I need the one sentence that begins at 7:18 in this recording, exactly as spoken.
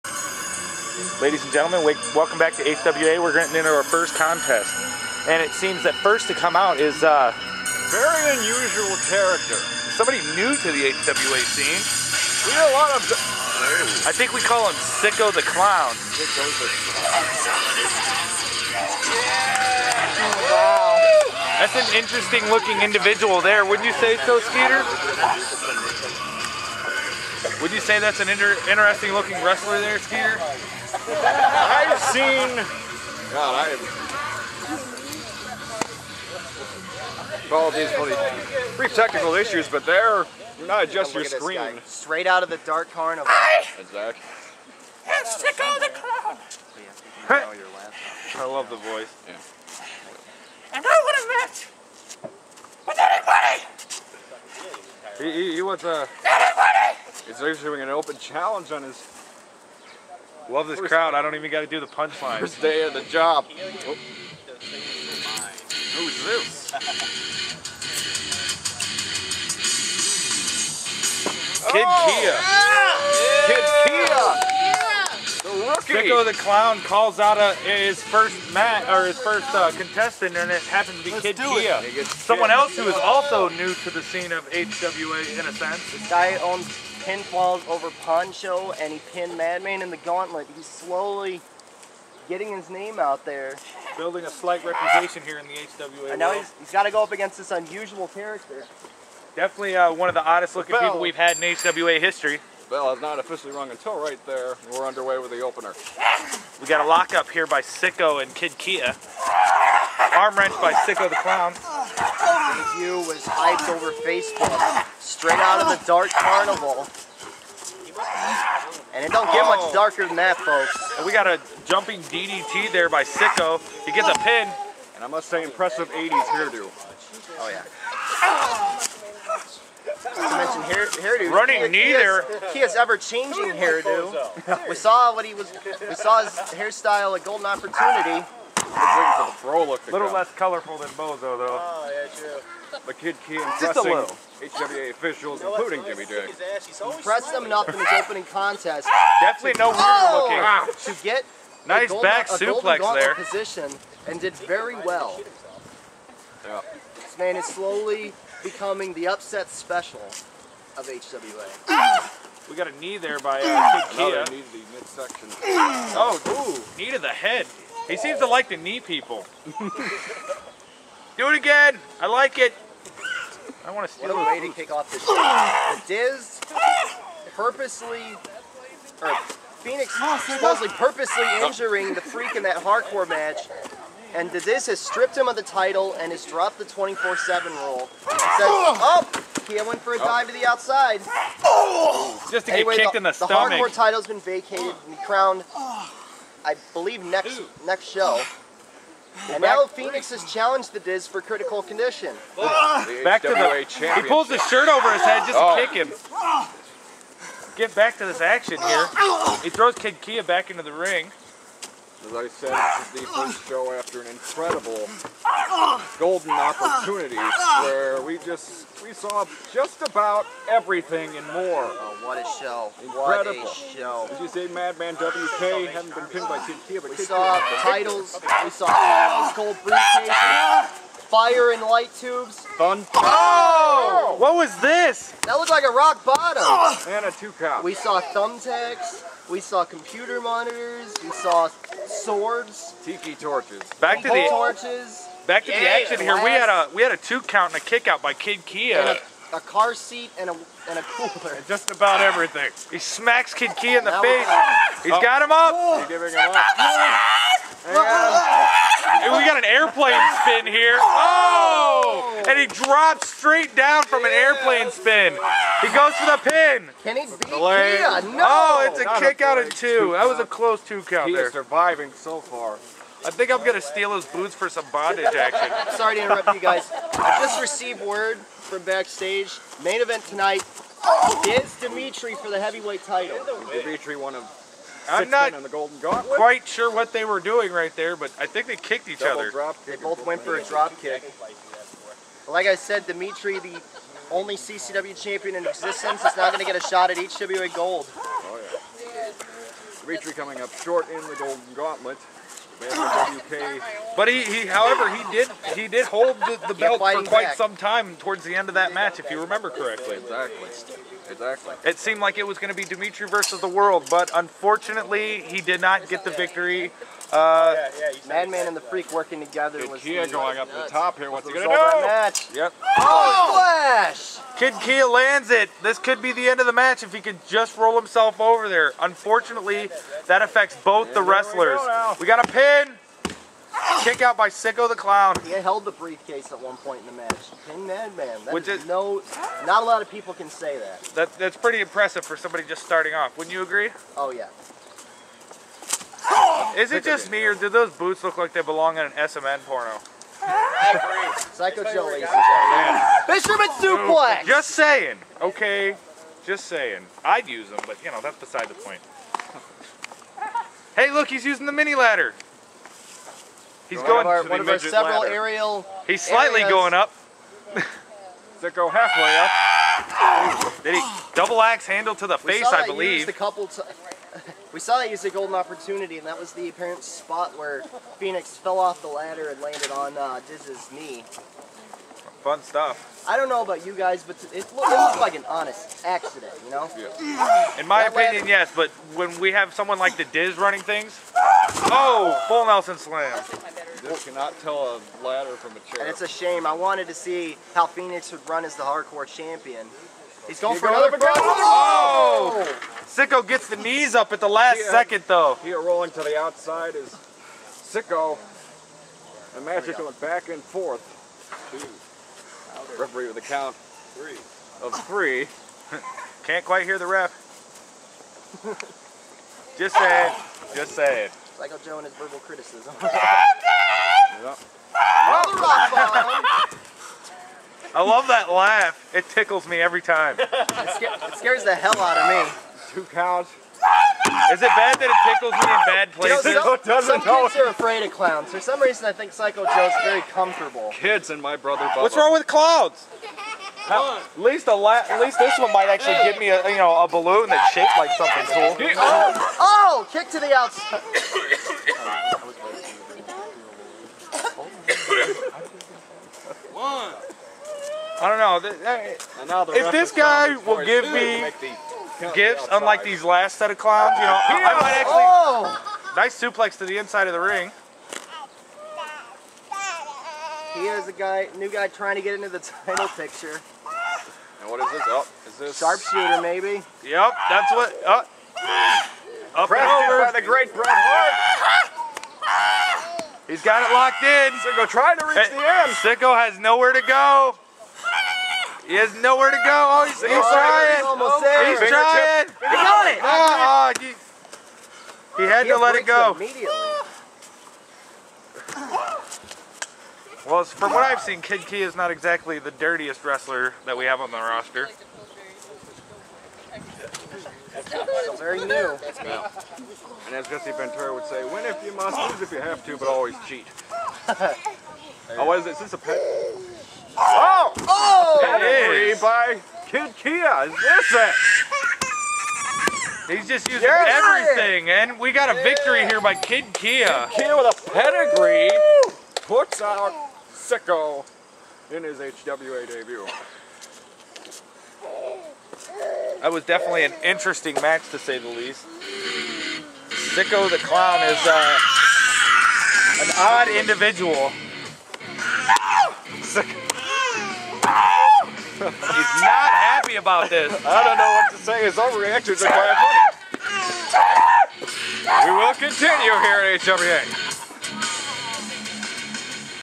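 For some reason, I think Psycho Joe's very comfortable.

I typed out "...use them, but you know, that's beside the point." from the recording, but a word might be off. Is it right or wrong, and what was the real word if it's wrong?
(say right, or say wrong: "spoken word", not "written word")
right.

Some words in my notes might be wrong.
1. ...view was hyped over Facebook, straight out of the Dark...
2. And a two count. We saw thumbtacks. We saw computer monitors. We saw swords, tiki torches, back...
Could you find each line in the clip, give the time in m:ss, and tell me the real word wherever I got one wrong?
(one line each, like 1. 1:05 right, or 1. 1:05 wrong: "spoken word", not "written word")
1. 1:52 right
2. 3:56 right.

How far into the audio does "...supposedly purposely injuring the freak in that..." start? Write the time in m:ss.
3:00.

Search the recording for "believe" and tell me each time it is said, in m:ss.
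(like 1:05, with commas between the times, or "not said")
3:16, 6:12.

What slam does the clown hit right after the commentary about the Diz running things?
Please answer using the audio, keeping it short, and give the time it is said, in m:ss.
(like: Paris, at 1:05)
full Nelson slam, at 6:32.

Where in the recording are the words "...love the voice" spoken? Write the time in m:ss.
0:48.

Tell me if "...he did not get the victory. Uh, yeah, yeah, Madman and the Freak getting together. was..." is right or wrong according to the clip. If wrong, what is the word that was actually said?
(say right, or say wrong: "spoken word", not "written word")
wrong: "working", not "getting".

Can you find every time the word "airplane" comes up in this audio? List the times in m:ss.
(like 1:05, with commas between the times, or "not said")
4:19, 4:24.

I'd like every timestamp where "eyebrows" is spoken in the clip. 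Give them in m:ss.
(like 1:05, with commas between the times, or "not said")
not said.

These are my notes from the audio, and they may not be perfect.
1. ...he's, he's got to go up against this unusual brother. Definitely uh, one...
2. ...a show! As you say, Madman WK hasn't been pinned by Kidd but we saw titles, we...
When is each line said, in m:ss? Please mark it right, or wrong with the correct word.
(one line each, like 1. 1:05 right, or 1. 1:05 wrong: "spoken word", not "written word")
1. 1:36 wrong: "character", not "brother"
2. 3:43 right.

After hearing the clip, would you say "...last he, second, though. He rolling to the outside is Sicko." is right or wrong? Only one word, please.
right.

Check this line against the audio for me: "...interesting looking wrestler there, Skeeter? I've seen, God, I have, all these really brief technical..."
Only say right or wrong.
right.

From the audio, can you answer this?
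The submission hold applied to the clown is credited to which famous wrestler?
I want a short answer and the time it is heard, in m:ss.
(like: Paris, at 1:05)
Bret Hart, at 8:00.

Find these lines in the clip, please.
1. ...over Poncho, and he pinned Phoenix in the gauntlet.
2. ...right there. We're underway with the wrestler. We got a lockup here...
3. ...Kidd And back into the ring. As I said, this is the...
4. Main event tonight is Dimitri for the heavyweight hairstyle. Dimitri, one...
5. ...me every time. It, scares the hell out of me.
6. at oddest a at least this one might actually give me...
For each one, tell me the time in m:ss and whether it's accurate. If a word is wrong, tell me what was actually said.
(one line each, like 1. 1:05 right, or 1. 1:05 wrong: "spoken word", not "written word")
1. 1:27 wrong: "Madman", not "Phoenix"
2. 1:43 wrong: "opener", not "wrestler"
3. 3:29 wrong: "Kia", not "And"
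4. 4:39 wrong: "title", not "hairstyle"
5. 7:09 right
6. 7:23 wrong: "least", not "oddest".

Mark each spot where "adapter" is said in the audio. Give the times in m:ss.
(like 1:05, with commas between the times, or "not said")
not said.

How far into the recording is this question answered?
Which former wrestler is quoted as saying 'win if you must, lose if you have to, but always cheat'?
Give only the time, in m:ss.
8:30.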